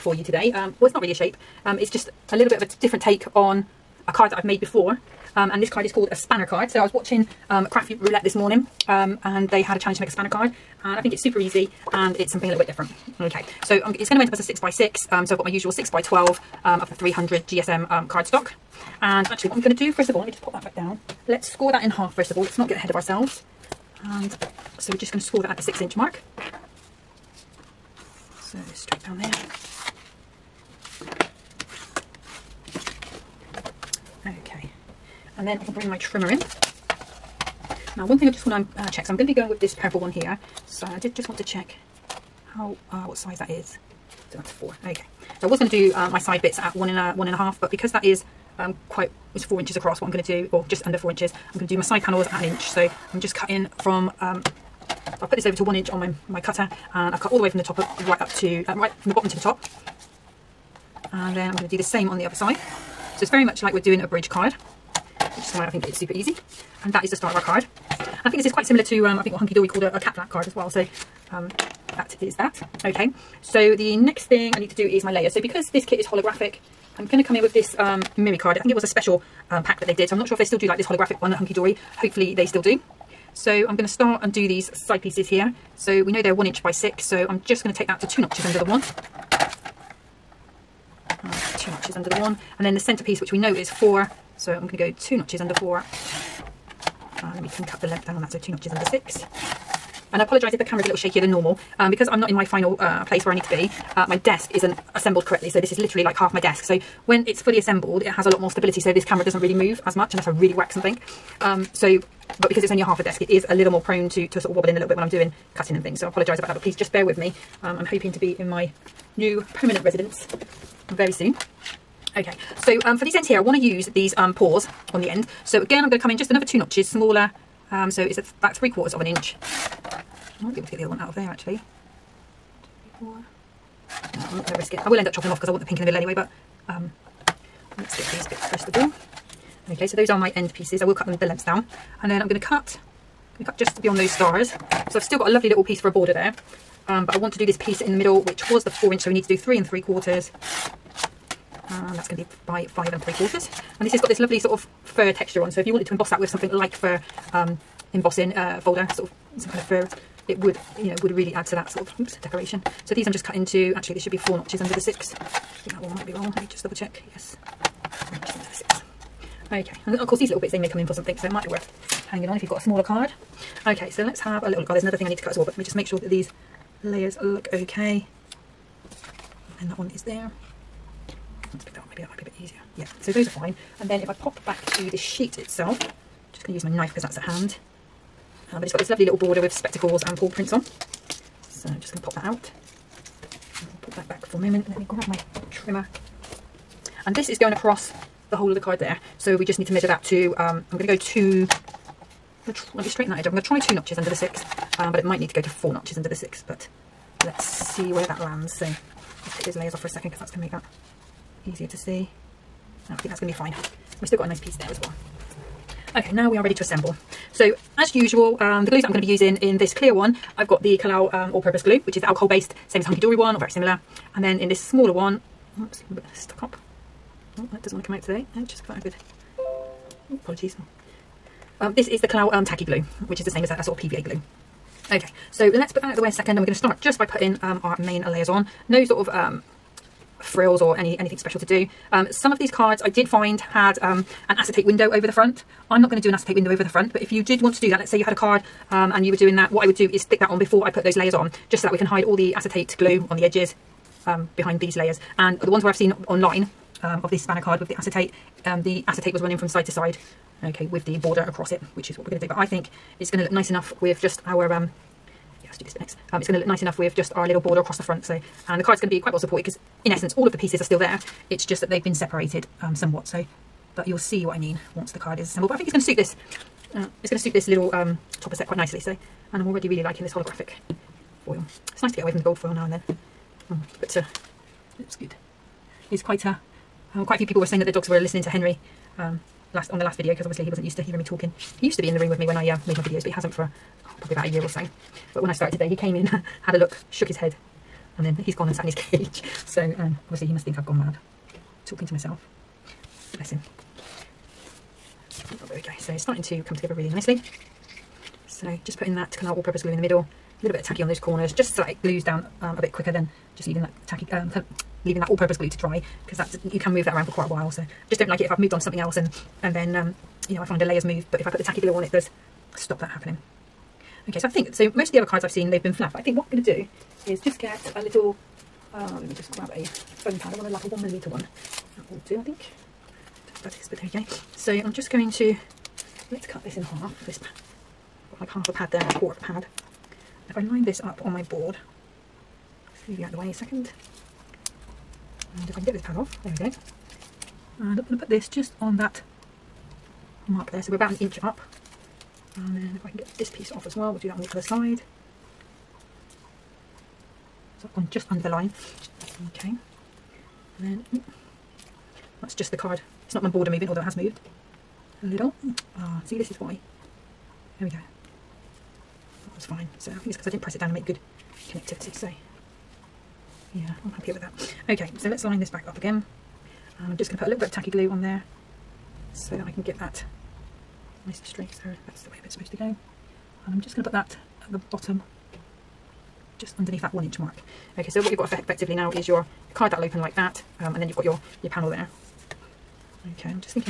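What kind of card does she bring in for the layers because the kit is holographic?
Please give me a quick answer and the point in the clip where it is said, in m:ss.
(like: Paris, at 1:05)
Mirri card, at 1:18.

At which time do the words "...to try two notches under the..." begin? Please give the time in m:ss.
3:23.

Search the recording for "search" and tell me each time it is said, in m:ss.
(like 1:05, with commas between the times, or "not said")
not said.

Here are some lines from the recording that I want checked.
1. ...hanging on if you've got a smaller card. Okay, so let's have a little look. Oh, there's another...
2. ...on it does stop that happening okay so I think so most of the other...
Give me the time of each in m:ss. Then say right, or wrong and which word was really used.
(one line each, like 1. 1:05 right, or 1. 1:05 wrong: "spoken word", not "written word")
1. 2:52 right
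2. 5:21 right.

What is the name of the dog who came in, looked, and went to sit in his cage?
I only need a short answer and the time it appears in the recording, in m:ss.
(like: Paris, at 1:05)
Henry, at 4:48.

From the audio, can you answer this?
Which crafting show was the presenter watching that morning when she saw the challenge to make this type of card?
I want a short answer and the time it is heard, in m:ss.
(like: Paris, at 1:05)
Crafty Roulette, at 0:07.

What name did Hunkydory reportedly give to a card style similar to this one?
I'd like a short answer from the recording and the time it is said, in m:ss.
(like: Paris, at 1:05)
cat flap card, at 1:09.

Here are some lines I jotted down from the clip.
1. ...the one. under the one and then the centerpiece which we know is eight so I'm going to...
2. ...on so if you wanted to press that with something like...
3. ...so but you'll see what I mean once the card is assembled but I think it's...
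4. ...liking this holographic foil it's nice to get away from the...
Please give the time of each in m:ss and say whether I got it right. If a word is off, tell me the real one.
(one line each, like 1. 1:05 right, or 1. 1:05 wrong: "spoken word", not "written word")
1. 1:28 wrong: "four", not "eight"
2. 2:35 wrong: "emboss", not "press"
3. 4:33 right
4. 4:39 right.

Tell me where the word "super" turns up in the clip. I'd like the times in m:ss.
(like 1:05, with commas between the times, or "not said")
0:11, 1:05.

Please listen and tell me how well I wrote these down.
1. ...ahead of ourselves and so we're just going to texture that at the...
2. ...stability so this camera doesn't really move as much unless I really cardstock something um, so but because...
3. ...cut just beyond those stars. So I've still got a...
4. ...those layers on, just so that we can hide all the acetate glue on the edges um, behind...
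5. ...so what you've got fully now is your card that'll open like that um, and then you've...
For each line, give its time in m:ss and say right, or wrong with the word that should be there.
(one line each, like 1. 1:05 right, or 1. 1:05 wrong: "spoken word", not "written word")
1. 0:22 wrong: "score", not "texture"
2. 1:48 wrong: "whack", not "cardstock"
3. 2:23 right
4. 4:10 right
5. 6:27 wrong: "effectively", not "fully".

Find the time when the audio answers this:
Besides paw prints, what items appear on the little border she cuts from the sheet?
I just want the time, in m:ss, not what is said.
3:09.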